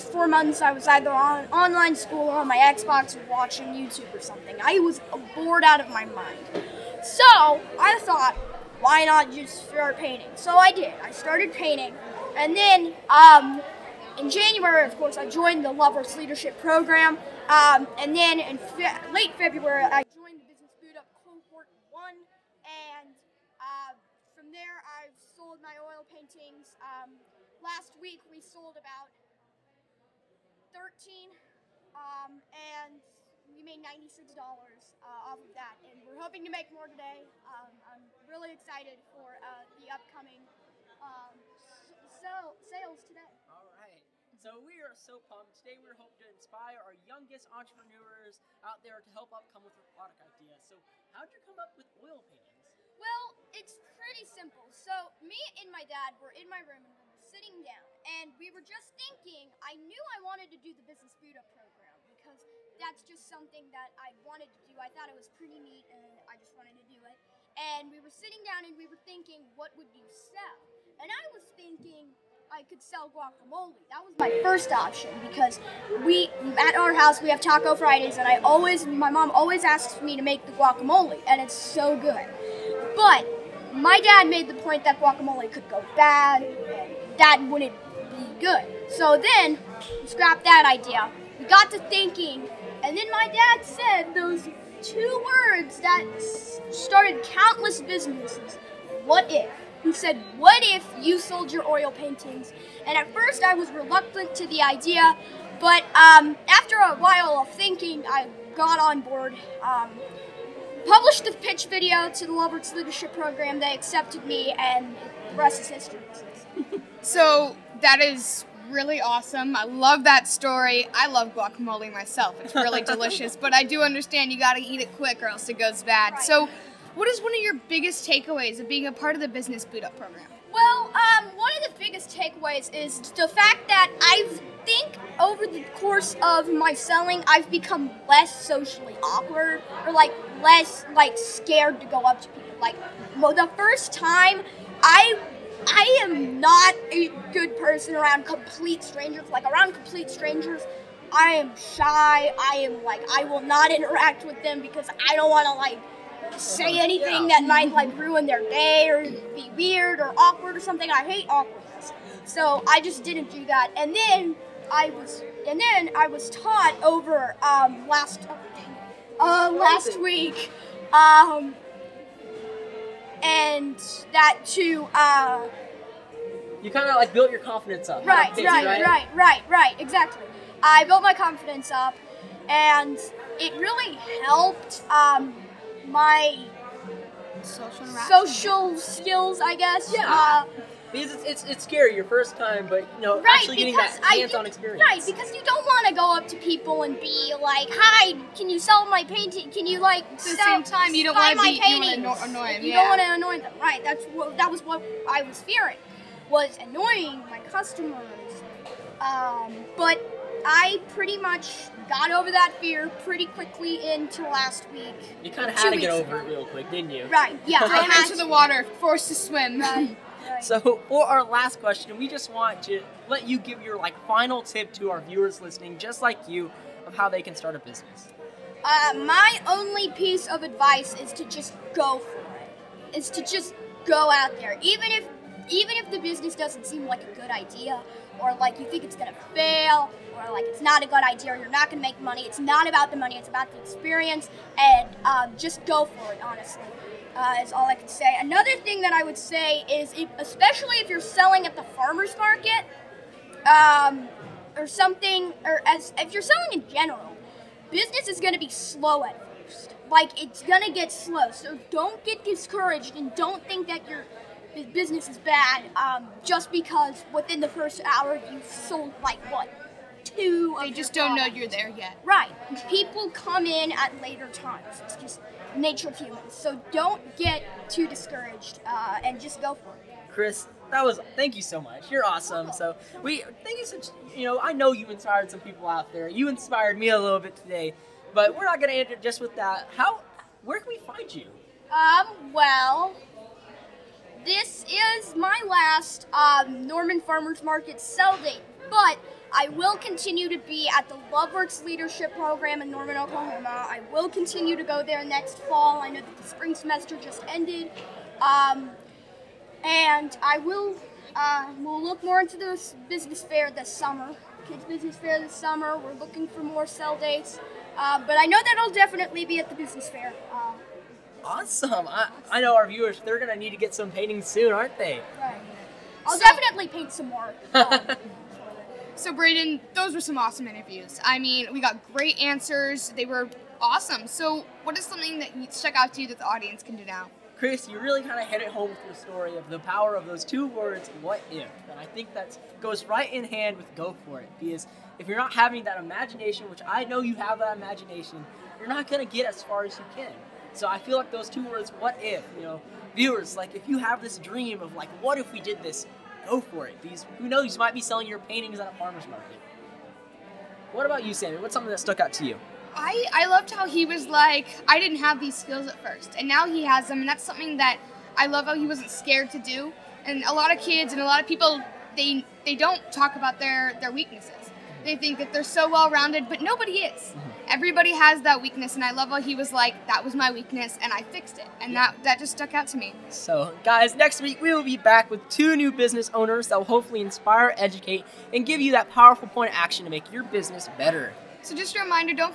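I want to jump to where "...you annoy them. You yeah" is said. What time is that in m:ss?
3:21.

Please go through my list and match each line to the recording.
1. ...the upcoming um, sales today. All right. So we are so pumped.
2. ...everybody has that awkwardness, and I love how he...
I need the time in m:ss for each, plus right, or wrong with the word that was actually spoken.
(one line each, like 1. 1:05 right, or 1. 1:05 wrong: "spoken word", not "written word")
1. 0:39 right
2. 6:17 wrong: "weakness", not "awkwardness".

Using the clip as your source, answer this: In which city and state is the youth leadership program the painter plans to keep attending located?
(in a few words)
Norman, Oklahoma.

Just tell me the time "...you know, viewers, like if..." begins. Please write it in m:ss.
5:52.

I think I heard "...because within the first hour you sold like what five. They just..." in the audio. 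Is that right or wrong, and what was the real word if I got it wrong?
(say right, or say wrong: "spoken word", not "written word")
wrong: "two", not "five".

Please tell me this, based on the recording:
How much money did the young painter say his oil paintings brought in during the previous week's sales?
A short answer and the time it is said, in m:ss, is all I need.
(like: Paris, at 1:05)
$96, at 0:33.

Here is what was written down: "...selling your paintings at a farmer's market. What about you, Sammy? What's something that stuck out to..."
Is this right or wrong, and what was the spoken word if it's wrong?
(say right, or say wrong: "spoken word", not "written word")
right.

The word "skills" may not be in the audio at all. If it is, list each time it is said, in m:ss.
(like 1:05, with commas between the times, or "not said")
3:08, 6:05.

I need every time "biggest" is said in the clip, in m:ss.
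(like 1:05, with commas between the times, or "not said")
2:07, 2:11.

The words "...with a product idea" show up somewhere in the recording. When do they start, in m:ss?
0:49.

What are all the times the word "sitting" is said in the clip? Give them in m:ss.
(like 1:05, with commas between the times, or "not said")
0:57, 1:08.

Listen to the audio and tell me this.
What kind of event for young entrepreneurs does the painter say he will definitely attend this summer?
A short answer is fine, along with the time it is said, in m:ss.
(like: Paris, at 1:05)
Kids Business Fair, at 5:14.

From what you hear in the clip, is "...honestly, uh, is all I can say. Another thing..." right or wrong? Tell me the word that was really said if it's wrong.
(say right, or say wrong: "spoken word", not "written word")
right.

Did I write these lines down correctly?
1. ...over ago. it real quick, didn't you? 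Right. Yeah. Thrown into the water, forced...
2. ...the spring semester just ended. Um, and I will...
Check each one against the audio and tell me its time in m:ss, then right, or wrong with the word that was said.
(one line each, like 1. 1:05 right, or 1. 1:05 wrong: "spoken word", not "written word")
1. 3:35 right
2. 5:06 right.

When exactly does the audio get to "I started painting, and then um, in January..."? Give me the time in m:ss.
0:11.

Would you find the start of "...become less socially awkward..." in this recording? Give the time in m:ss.
2:17.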